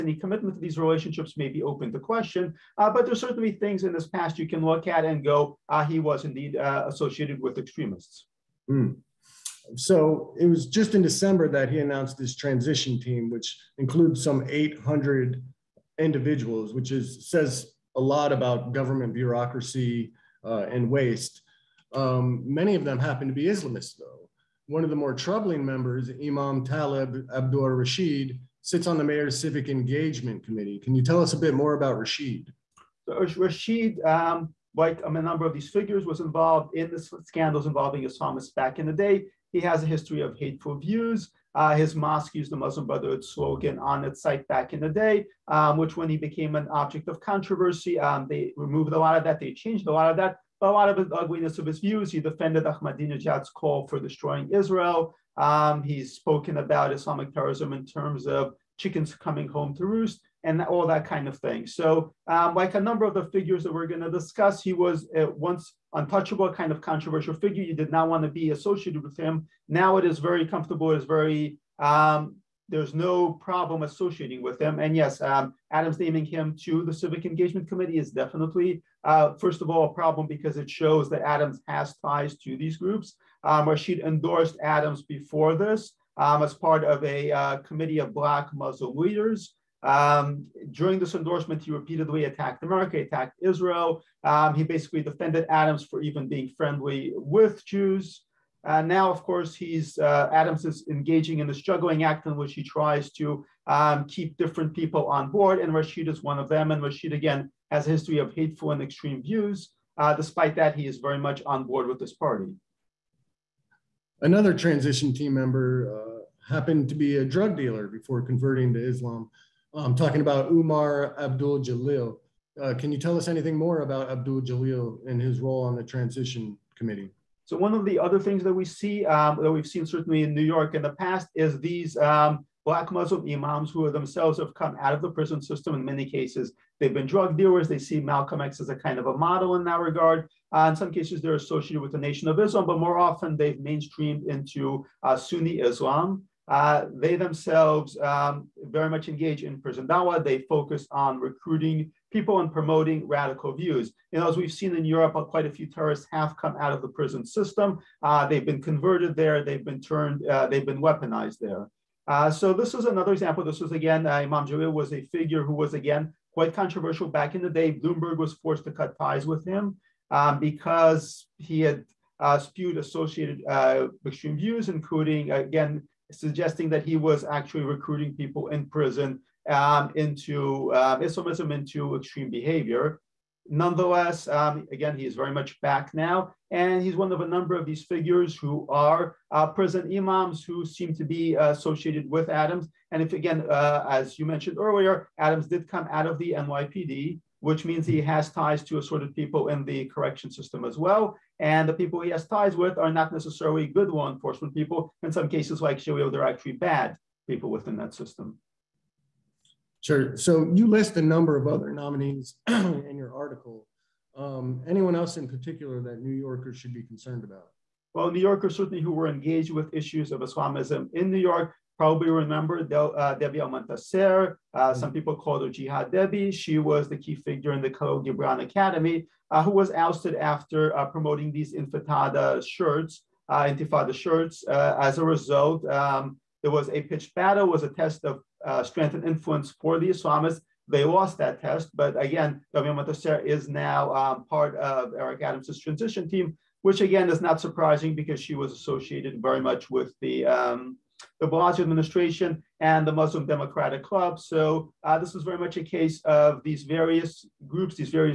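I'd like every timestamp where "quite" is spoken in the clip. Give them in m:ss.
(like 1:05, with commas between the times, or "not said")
2:35, 2:46.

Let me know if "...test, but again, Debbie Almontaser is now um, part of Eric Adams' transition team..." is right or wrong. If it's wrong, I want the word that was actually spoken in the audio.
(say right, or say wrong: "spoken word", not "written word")
right.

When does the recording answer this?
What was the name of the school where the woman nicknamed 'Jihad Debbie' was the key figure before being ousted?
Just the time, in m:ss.
3:47.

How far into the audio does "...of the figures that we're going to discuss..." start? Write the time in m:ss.
1:03.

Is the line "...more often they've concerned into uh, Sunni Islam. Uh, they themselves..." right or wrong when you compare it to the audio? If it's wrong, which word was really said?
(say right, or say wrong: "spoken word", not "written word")
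wrong: "mainstreamed", not "concerned".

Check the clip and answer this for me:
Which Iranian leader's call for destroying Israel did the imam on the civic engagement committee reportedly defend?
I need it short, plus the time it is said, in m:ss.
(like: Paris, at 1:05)
Ahmadinejad, at 0:52.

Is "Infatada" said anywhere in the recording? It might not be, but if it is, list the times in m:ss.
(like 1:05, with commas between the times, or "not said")
3:51.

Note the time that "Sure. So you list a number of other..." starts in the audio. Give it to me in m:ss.
3:29.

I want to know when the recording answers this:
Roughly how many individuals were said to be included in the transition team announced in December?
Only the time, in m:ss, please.
0:14.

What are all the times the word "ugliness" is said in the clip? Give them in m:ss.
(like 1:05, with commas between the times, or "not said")
0:51.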